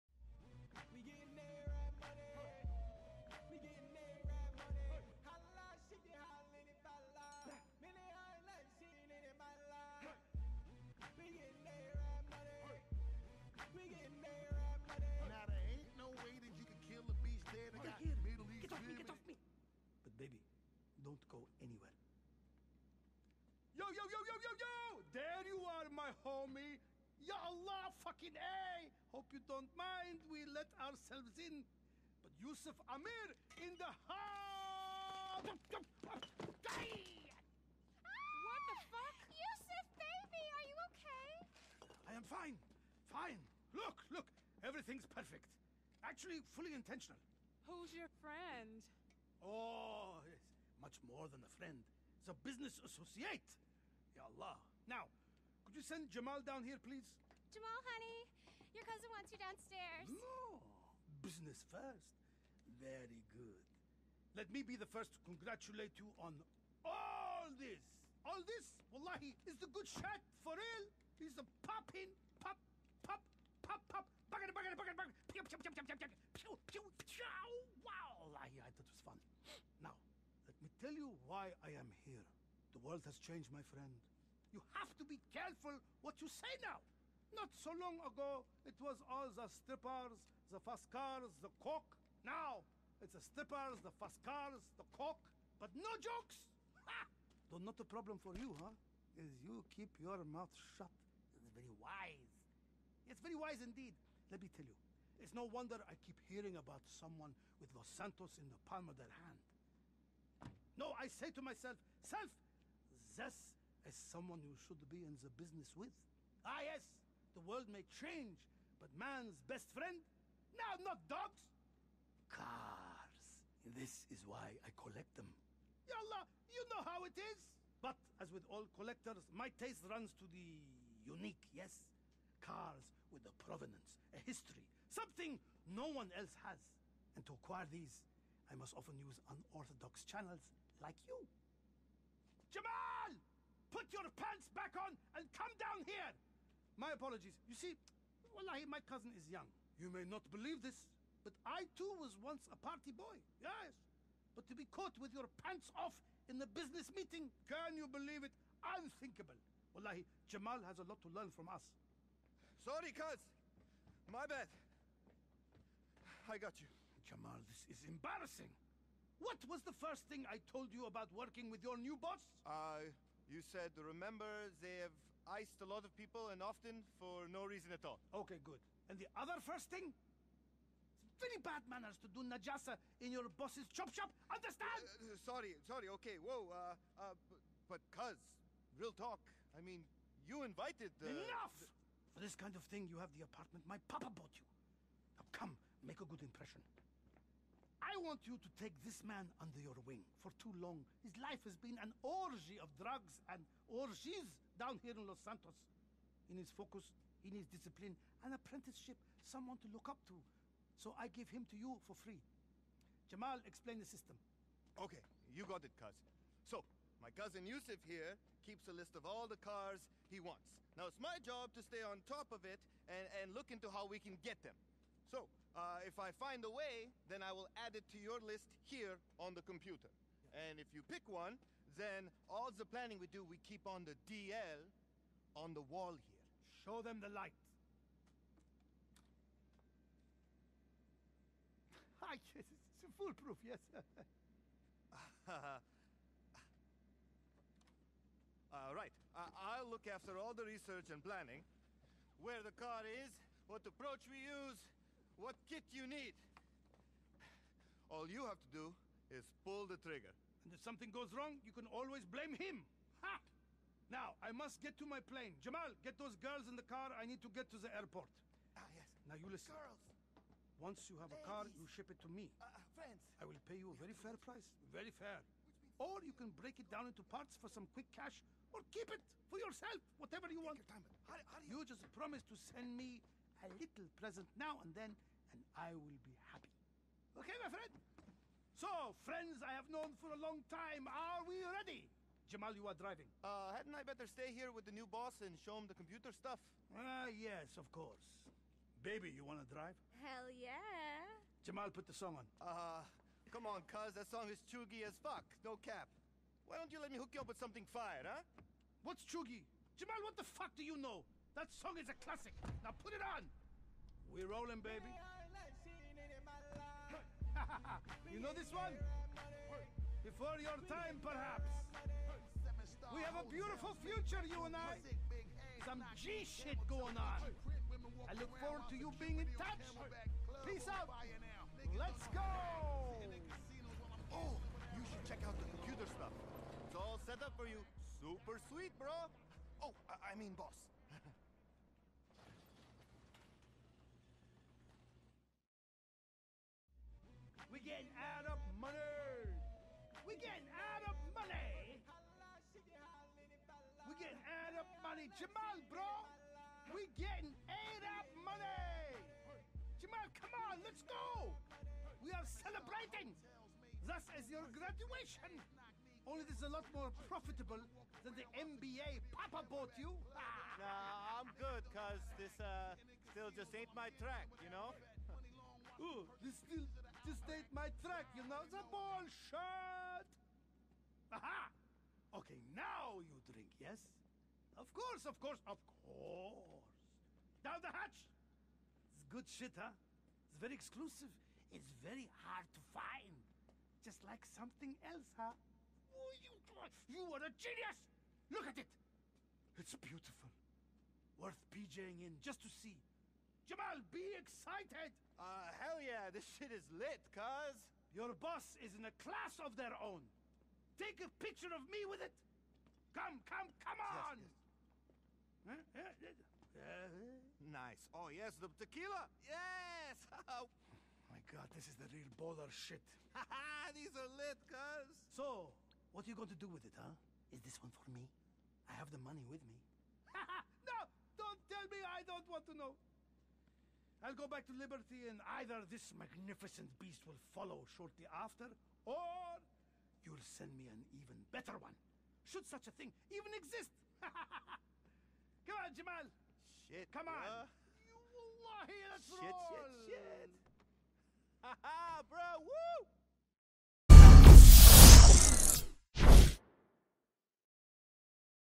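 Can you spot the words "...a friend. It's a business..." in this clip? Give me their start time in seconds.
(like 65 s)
51 s.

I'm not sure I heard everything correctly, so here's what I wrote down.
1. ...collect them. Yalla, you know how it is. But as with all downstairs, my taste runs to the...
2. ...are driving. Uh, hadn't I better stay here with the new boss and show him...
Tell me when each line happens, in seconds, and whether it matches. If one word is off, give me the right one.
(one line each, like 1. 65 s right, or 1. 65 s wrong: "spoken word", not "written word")
1. 124 s wrong: "collectors", not "downstairs"
2. 292 s right.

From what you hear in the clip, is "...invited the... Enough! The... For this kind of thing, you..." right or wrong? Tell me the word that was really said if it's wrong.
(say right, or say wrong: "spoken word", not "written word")
right.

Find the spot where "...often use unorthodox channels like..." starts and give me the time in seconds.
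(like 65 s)
138 s.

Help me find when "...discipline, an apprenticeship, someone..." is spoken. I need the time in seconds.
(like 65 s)
207 s.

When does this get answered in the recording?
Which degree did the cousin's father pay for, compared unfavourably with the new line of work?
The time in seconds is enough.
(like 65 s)
368 s.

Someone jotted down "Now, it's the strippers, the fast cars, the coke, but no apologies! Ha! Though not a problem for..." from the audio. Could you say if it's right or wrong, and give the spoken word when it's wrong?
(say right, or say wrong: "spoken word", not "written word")
wrong: "jokes", not "apologies".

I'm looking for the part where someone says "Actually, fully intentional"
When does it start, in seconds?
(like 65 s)
46 s.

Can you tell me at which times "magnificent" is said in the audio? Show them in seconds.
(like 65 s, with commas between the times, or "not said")
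435 s.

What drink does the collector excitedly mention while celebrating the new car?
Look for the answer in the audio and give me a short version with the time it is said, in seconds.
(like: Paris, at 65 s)
tequila, at 418 s.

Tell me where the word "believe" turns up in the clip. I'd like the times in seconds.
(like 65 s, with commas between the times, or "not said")
150 s, 157 s.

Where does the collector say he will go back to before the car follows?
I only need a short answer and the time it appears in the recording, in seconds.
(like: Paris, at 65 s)
Liberty, at 434 s.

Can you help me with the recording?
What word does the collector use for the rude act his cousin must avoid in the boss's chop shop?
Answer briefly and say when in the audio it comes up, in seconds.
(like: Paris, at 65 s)
najasa, at 182 s.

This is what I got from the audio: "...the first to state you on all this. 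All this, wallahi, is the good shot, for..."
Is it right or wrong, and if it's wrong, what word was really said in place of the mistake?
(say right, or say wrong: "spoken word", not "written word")
wrong: "congratulate", not "state".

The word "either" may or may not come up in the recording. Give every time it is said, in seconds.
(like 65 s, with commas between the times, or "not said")
435 s.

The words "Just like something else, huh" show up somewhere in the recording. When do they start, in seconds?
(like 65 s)
393 s.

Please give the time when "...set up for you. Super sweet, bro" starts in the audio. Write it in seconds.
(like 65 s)
337 s.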